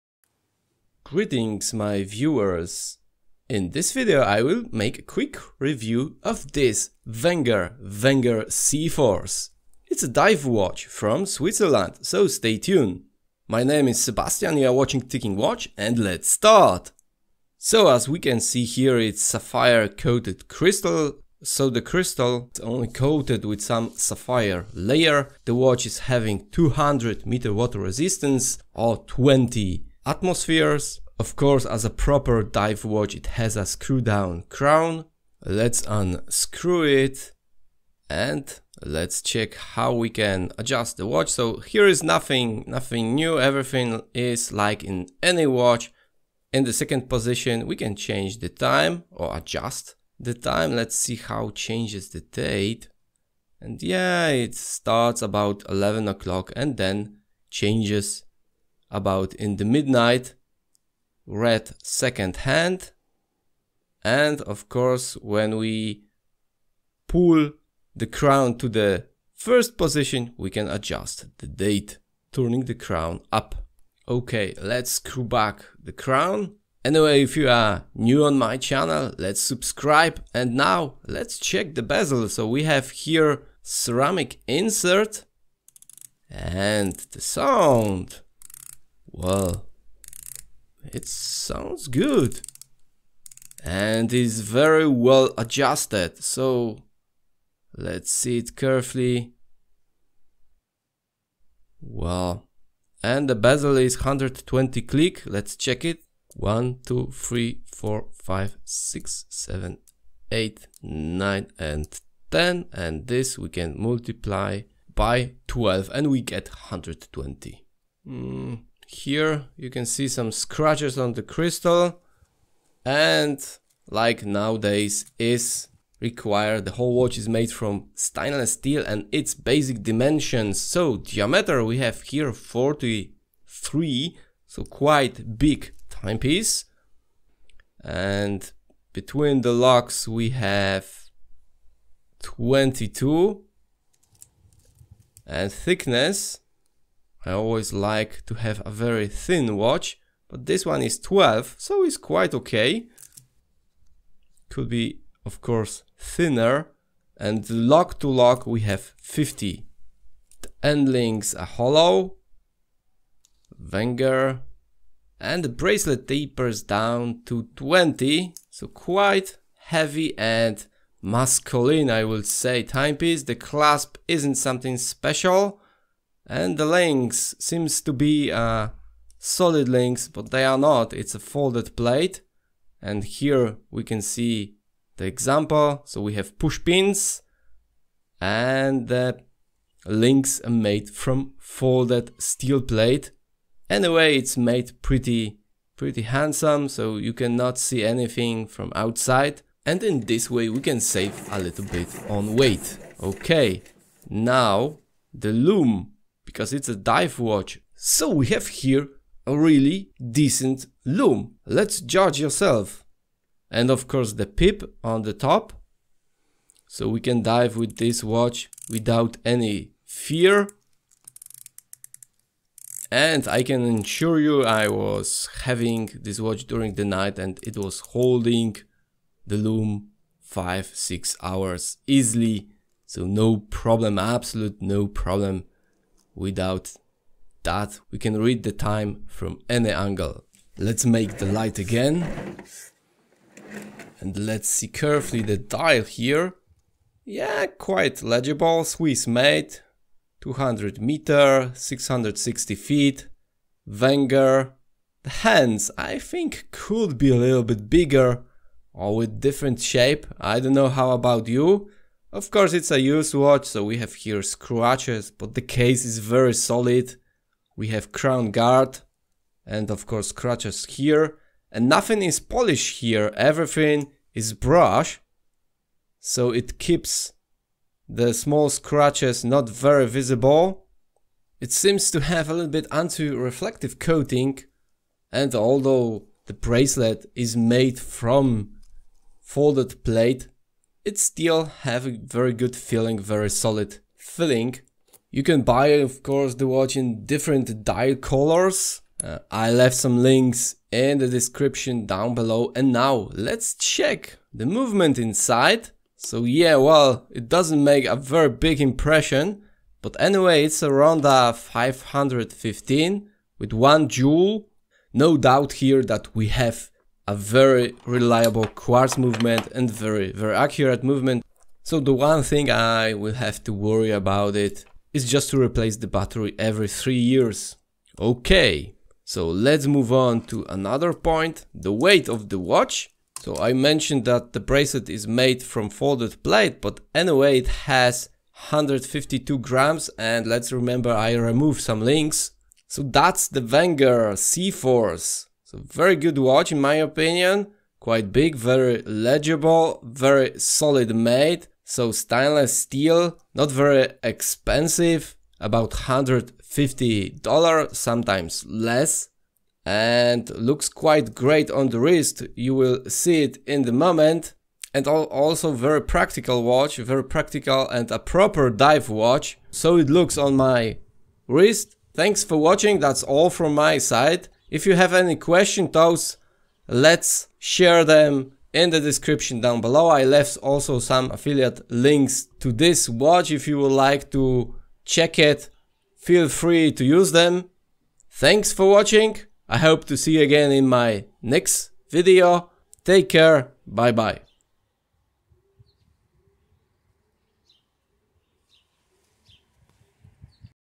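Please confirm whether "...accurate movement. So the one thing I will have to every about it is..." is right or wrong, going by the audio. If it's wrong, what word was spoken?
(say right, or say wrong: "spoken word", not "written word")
wrong: "worry", not "every".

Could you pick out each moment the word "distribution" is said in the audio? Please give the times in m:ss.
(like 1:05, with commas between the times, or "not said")
not said.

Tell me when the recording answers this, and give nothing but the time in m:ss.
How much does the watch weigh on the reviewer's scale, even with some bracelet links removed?
5:38.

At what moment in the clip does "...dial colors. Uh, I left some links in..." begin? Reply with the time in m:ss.
4:57.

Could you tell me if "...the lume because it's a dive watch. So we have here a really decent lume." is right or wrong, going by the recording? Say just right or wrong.
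right.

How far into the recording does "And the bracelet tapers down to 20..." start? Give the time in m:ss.
2:45.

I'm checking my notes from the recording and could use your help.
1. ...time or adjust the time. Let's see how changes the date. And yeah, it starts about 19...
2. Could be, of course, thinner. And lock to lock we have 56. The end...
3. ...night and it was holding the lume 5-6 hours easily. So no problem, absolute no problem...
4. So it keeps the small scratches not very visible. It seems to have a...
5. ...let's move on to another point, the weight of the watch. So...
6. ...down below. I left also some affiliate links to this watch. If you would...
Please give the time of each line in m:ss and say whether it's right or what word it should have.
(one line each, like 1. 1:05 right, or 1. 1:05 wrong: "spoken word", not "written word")
1. 0:48 wrong: "11", not "19"
2. 2:34 wrong: "50", not "56"
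3. 3:46 right
4. 4:35 right
5. 5:29 right
6. 6:19 right.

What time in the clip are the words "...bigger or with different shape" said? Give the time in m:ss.
4:17.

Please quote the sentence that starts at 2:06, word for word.
The whole watch is made from stainless steel and its basic dimensions.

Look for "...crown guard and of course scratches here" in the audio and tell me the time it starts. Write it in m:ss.
4:27.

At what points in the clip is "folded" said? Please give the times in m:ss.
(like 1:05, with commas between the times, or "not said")
3:01, 3:11, 4:49, 5:35.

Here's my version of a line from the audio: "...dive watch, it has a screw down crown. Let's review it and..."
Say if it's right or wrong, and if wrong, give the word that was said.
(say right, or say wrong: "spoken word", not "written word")
wrong: "unscrew", not "review".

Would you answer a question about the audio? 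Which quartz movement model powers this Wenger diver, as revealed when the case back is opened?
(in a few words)
Ronda 515.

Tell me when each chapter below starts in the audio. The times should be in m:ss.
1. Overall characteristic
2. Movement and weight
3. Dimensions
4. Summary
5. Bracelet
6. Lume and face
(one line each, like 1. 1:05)
1. 0:20
2. 4:55
3. 2:09
4. 5:40
5. 2:50
6. 3:23.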